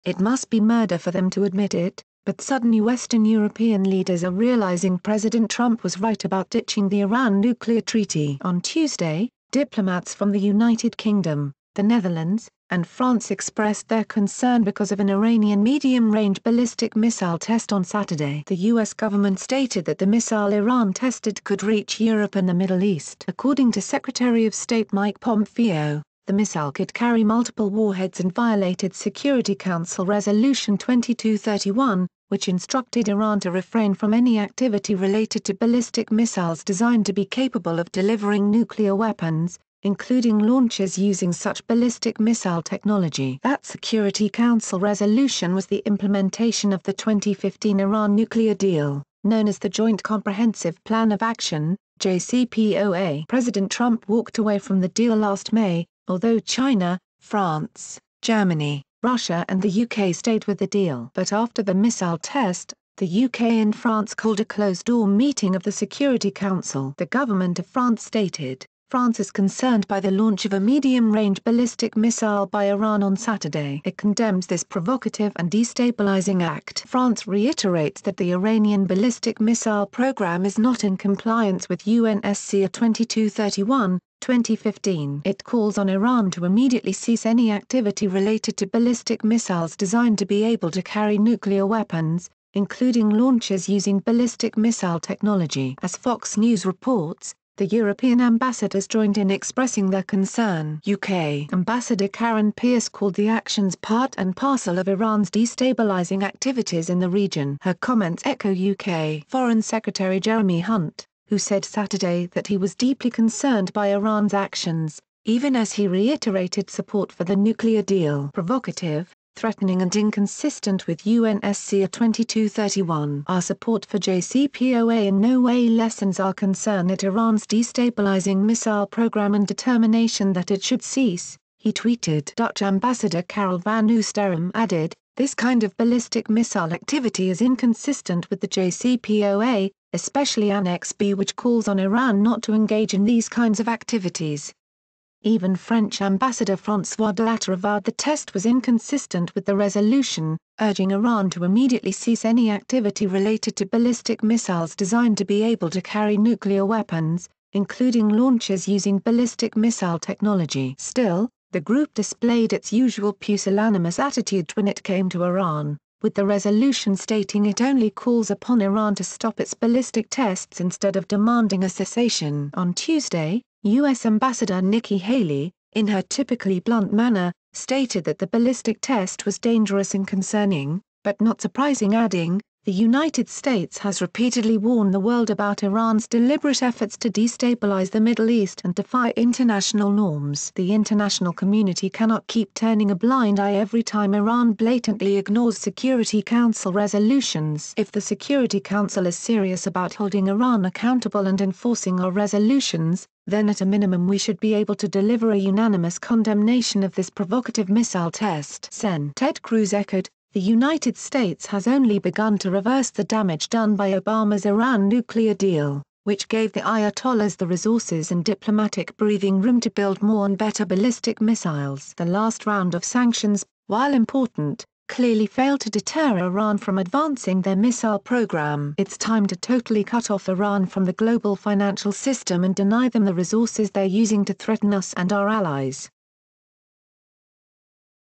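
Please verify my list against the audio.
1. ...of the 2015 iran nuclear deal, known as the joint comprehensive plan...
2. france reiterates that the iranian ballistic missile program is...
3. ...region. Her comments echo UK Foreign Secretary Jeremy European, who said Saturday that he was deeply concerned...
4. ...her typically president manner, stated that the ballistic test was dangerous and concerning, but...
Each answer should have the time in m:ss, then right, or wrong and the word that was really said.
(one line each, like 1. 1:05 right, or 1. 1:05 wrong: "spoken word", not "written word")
1. 0:46 right
2. 1:16 right
3. 1:47 wrong: "Hunt", not "European"
4. 2:55 wrong: "blunt", not "president".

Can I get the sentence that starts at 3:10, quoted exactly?
the international community cannot keep turning a blind eye every time iran blatantly ignores security council resolutions.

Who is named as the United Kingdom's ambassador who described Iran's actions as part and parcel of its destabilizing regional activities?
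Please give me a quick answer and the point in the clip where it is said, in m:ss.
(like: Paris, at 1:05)
Karen Pierce, at 1:42.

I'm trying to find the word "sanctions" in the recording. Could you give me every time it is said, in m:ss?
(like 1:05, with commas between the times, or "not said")
3:42.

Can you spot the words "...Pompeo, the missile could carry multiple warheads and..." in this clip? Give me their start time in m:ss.
0:25.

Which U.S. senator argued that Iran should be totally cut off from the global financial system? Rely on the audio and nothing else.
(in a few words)
Ted Cruz.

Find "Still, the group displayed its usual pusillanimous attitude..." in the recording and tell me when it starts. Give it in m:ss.
2:40.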